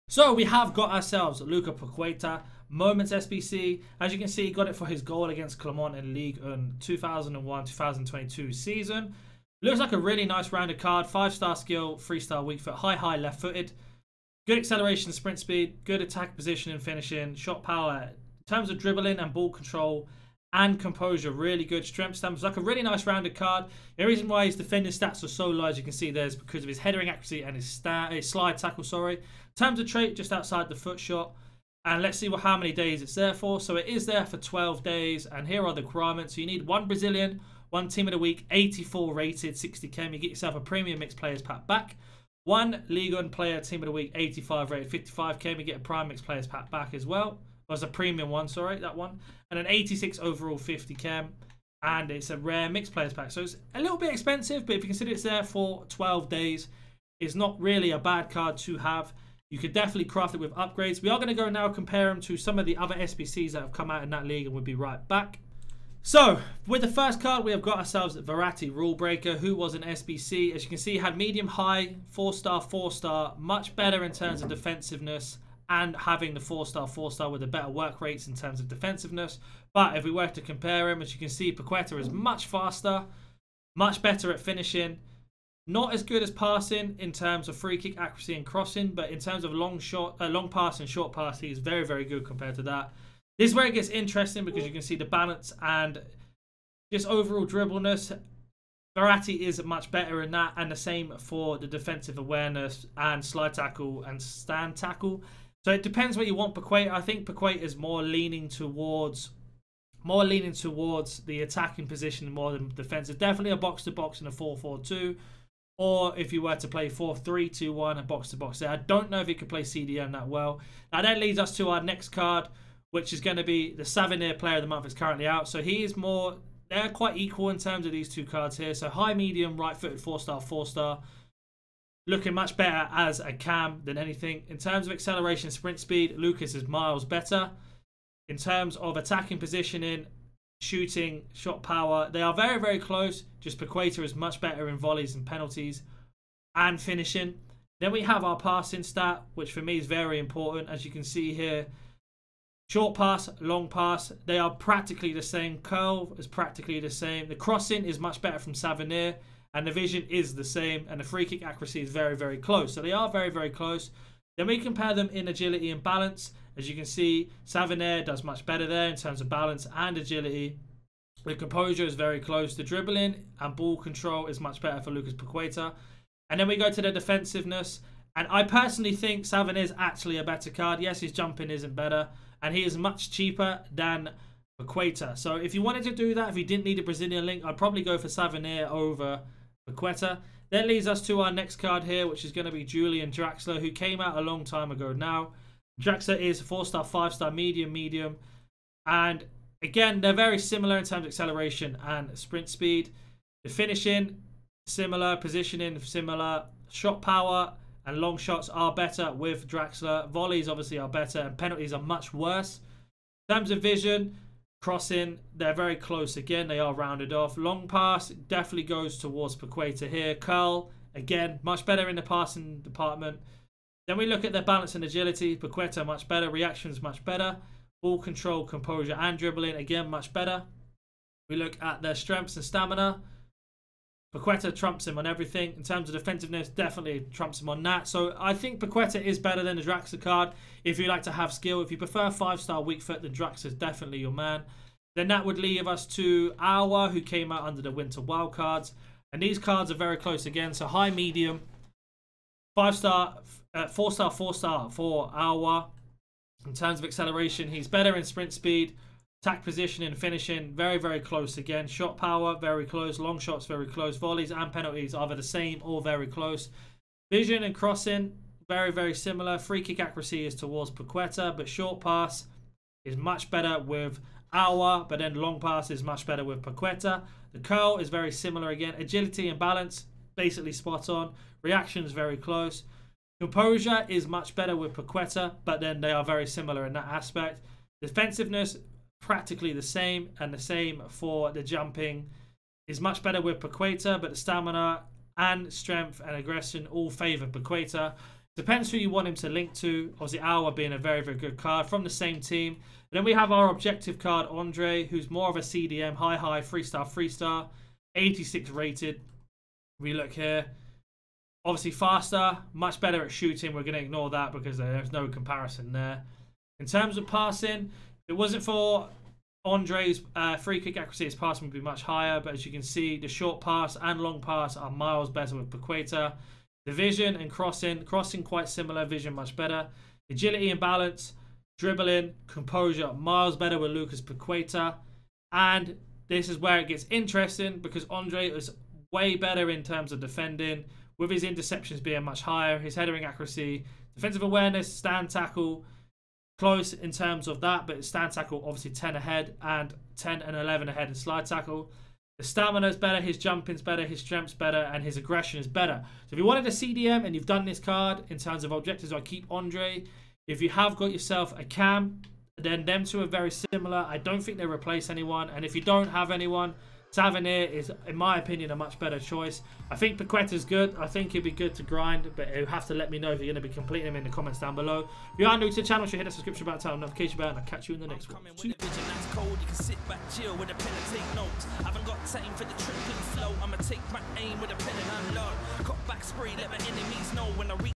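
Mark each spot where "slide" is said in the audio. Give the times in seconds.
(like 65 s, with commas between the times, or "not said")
28 s, 103 s, 350 s.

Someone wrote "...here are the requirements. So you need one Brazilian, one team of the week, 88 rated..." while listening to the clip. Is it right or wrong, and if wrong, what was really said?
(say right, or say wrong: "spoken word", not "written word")
wrong: "84", not "88".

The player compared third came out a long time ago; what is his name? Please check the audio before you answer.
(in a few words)
Julian Draxler.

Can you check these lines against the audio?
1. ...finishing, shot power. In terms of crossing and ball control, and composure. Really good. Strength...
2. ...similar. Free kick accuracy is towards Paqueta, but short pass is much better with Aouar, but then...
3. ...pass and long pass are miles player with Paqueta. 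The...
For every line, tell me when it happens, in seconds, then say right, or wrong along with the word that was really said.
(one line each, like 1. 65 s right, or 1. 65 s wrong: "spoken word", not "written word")
1. 16 s wrong: "dribbling", not "crossing"
2. 268 s right
3. 323 s wrong: "better", not "player".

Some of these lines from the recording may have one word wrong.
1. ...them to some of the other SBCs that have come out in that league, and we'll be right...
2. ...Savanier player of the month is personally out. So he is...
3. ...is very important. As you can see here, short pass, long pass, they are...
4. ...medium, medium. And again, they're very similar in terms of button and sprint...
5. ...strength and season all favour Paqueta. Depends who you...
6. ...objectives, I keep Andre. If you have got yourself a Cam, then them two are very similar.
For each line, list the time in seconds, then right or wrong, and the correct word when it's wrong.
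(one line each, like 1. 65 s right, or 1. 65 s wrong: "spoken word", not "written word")
1. 62 s right
2. 123 s wrong: "currently", not "personally"
3. 149 s right
4. 197 s wrong: "acceleration", not "button"
5. 295 s wrong: "aggression", not "season"
6. 358 s right.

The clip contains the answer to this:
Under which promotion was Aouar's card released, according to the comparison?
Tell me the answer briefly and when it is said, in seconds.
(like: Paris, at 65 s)
winter wild cards, at 247 s.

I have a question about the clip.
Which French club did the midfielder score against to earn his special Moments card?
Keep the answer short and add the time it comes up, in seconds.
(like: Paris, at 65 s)
Clermont, at 5 s.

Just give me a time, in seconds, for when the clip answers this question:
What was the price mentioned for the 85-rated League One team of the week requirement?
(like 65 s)
45 s.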